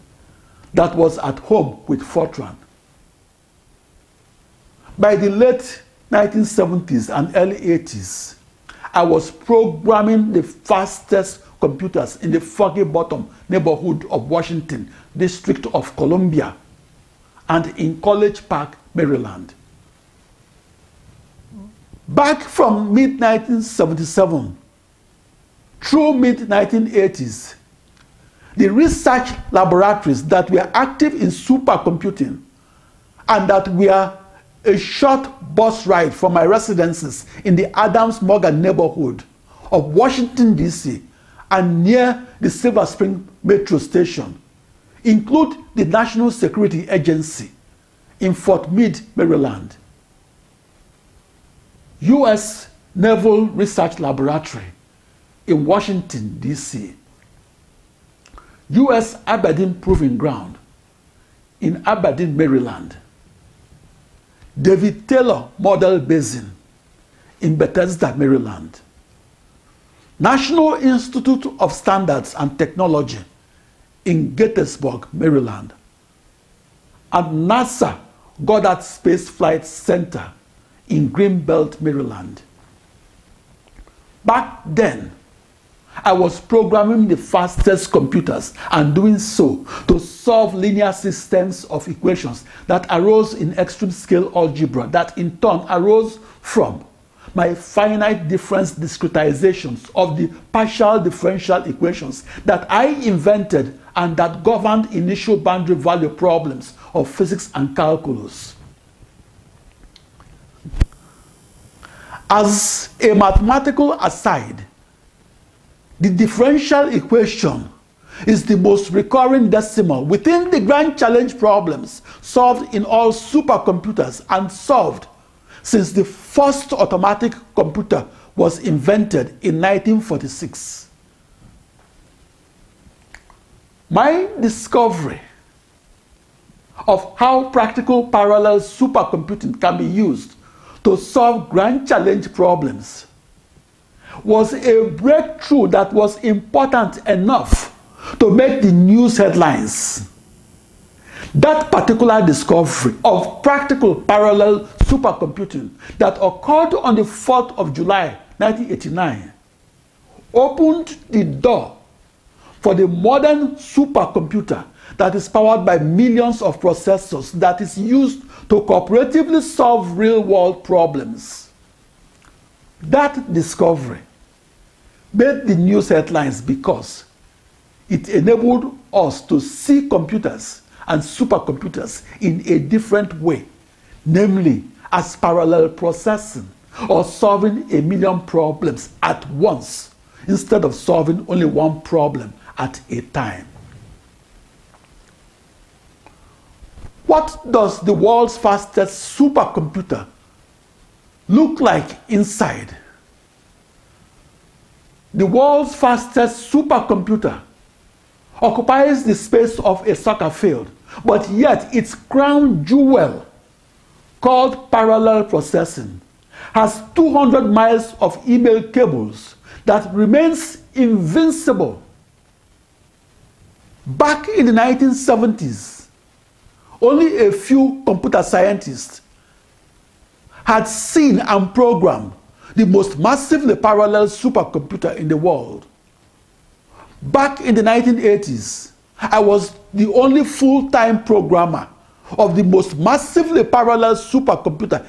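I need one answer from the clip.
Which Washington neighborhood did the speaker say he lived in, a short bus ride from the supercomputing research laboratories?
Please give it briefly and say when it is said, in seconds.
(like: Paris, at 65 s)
Adams Morgan, at 37 s.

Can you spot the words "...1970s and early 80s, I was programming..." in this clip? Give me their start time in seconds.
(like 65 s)
6 s.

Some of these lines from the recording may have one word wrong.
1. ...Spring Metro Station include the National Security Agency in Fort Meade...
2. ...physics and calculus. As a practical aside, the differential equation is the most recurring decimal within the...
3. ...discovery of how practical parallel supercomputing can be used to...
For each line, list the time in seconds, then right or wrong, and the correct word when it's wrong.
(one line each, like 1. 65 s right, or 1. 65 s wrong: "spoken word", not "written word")
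1. 42 s right
2. 107 s wrong: "mathematical", not "practical"
3. 134 s right.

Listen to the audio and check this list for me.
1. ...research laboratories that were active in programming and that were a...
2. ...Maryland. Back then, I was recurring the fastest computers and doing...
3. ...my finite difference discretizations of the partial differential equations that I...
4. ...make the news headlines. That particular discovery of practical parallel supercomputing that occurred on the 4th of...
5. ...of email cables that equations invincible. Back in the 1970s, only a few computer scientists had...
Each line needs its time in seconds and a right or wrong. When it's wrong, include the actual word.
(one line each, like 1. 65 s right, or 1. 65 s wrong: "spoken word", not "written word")
1. 28 s wrong: "supercomputing", not "programming"
2. 81 s wrong: "programming", not "recurring"
3. 97 s right
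4. 148 s right
5. 217 s wrong: "remains", not "equations".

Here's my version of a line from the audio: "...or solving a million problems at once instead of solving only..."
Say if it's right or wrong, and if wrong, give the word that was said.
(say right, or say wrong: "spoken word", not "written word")
right.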